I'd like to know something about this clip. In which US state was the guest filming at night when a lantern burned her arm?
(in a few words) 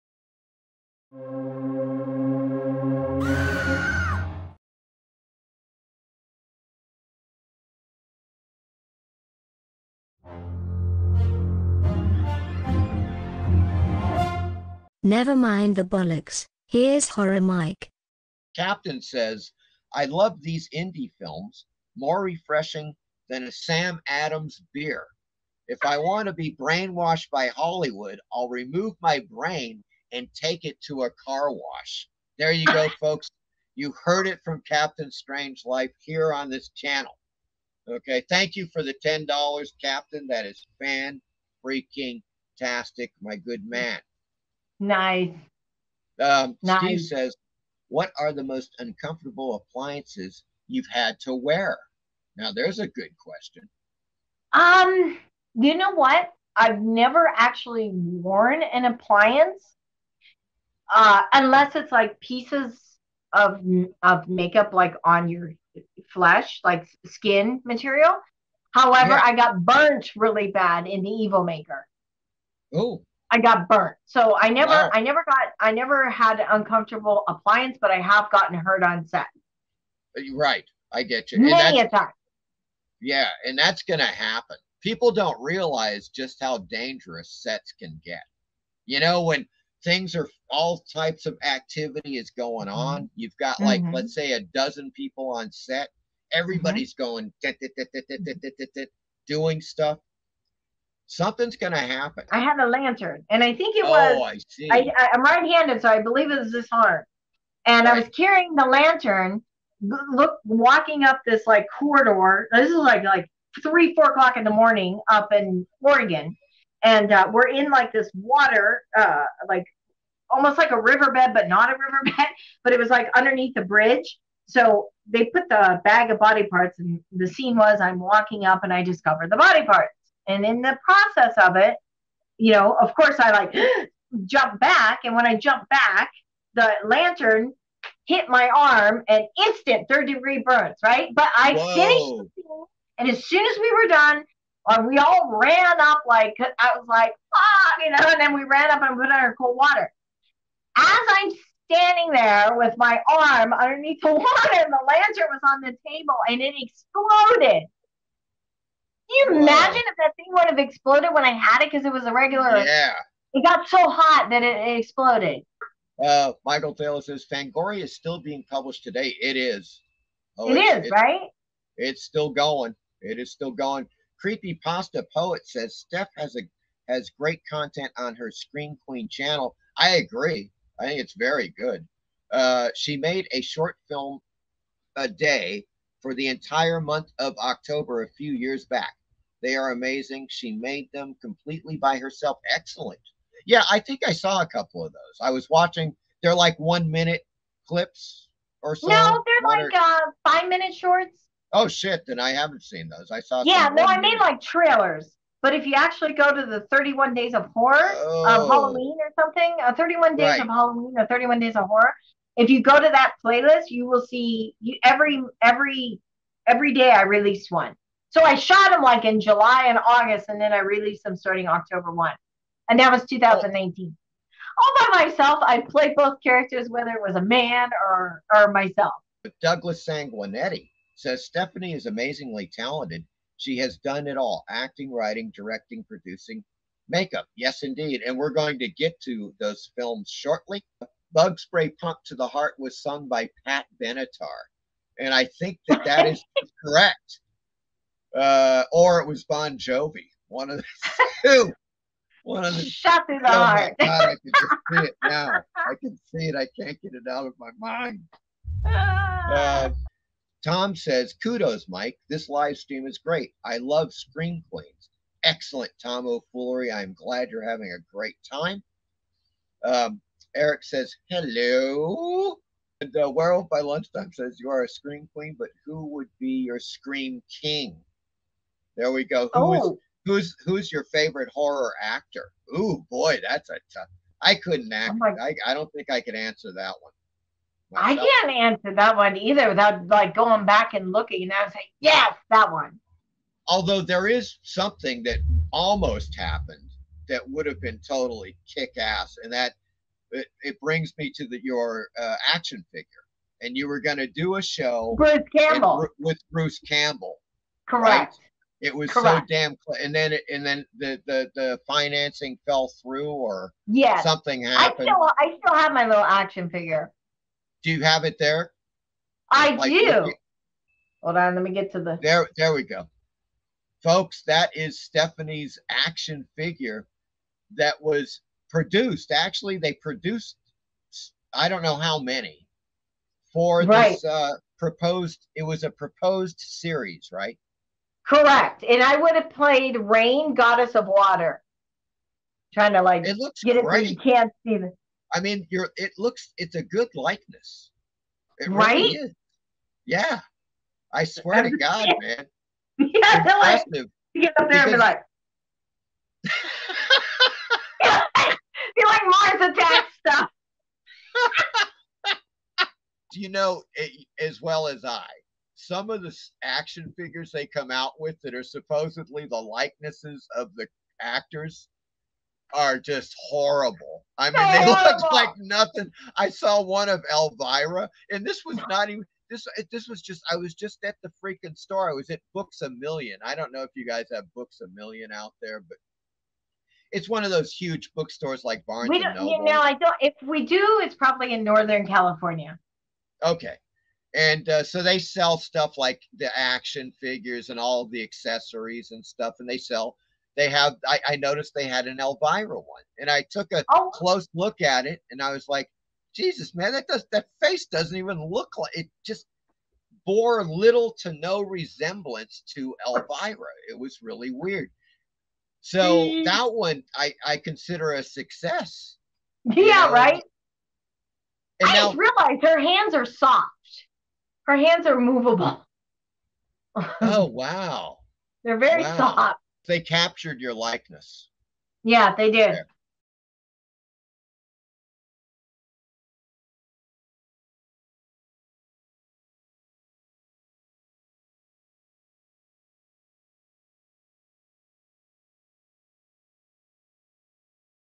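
Oregon.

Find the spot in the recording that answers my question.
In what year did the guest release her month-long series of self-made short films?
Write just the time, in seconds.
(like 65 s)
223 s.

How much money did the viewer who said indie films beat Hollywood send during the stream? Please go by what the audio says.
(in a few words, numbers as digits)
$10.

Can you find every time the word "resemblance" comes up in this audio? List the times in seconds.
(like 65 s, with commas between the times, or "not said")
411 s.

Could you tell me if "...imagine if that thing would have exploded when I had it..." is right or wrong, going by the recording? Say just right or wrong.
right.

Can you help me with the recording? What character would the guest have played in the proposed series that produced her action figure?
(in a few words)
Rain, Goddess of Water.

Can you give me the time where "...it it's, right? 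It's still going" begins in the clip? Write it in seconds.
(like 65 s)
170 s.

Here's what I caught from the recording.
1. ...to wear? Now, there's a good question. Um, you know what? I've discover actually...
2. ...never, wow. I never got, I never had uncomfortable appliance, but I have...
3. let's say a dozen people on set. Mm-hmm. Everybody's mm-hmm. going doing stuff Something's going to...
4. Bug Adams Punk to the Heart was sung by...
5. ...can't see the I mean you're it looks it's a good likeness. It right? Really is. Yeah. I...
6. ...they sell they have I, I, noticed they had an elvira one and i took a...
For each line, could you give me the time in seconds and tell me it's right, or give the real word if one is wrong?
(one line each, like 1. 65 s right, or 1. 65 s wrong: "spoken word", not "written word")
1. 51 s wrong: "never", not "discover"
2. 74 s right
3. 93 s right
4. 241 s wrong: "Spray", not "Adams"
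5. 343 s right
6. 399 s right.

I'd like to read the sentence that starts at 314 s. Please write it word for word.
I still, I still have my little action figure.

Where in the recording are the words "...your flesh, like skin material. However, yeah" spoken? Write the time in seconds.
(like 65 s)
65 s.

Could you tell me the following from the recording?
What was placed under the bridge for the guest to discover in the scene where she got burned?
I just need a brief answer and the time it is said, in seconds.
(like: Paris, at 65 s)
bag of body parts, at 125 s.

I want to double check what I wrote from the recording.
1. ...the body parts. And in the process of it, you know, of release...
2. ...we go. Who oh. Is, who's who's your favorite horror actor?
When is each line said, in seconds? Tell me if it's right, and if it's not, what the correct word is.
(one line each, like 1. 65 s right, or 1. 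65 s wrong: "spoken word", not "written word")
1. 129 s wrong: "course", not "release"
2. 278 s right.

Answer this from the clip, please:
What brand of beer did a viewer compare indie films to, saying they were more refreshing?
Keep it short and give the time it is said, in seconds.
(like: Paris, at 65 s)
Sam Adams, at 23 s.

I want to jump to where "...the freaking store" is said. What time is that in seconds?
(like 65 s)
381 s.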